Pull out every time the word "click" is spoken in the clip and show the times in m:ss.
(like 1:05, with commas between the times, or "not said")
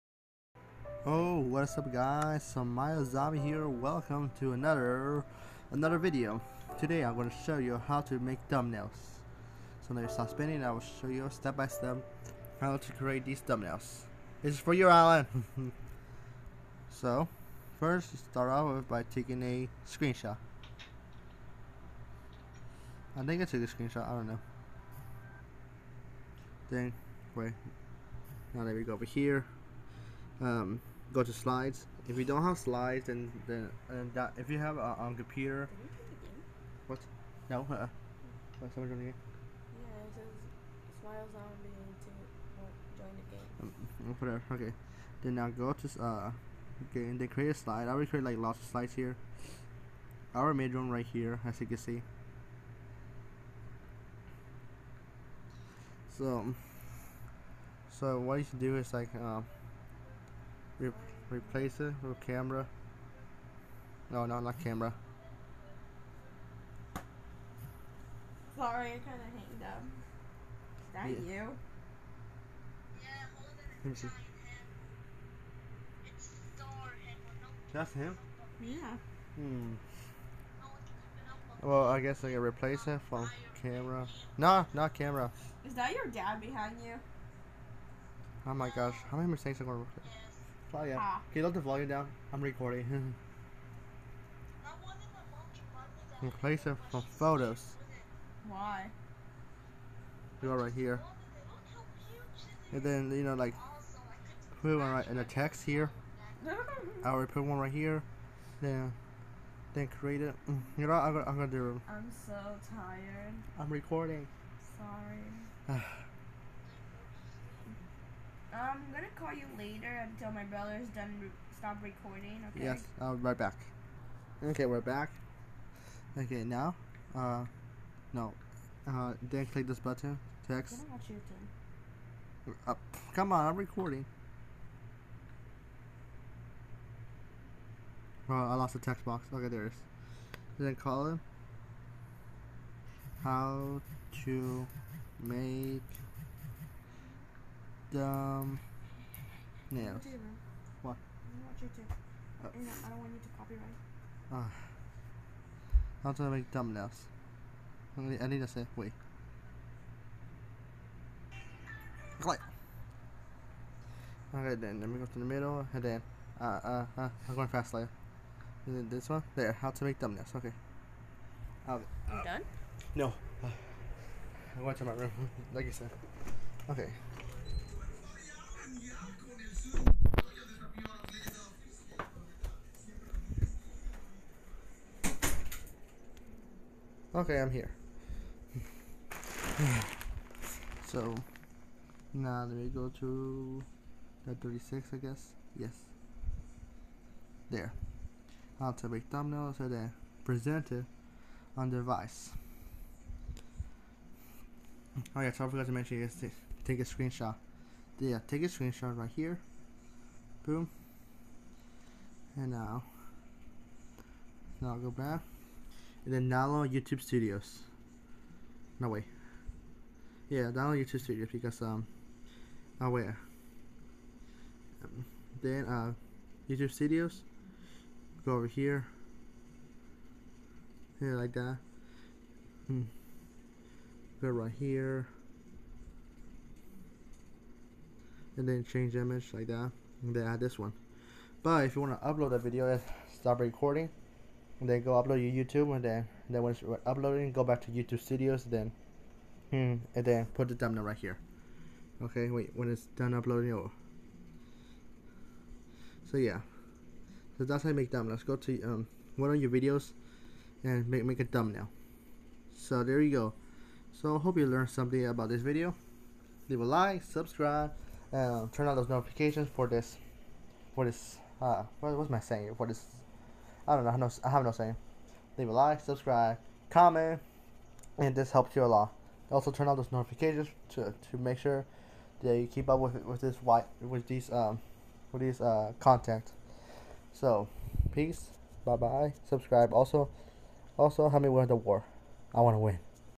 2:09, 2:42.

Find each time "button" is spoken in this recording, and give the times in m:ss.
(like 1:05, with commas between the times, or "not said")
2:09.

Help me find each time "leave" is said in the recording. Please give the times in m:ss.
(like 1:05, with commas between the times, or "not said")
4:26, 4:35.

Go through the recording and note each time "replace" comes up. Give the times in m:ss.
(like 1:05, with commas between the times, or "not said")
1:01, 1:22, 1:36.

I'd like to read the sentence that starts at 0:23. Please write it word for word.
I think I took a screenshot, I don't know.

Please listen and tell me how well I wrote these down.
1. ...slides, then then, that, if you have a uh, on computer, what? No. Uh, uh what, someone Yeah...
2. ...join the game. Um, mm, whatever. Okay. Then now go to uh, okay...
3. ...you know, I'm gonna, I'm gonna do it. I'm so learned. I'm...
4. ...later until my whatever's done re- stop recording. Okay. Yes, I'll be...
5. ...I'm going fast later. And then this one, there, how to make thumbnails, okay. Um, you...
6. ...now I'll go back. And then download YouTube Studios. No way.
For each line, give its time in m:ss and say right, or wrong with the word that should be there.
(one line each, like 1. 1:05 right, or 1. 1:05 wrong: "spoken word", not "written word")
1. 0:32 right
2. 0:42 right
3. 1:50 wrong: "tired", not "learned"
4. 1:59 wrong: "brother", not "whatever"
5. 2:47 right
6. 3:34 right.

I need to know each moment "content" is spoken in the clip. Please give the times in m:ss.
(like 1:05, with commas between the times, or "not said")
4:45.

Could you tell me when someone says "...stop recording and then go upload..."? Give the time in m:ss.
4:03.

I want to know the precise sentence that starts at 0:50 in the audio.
I already made one right here, as you can see.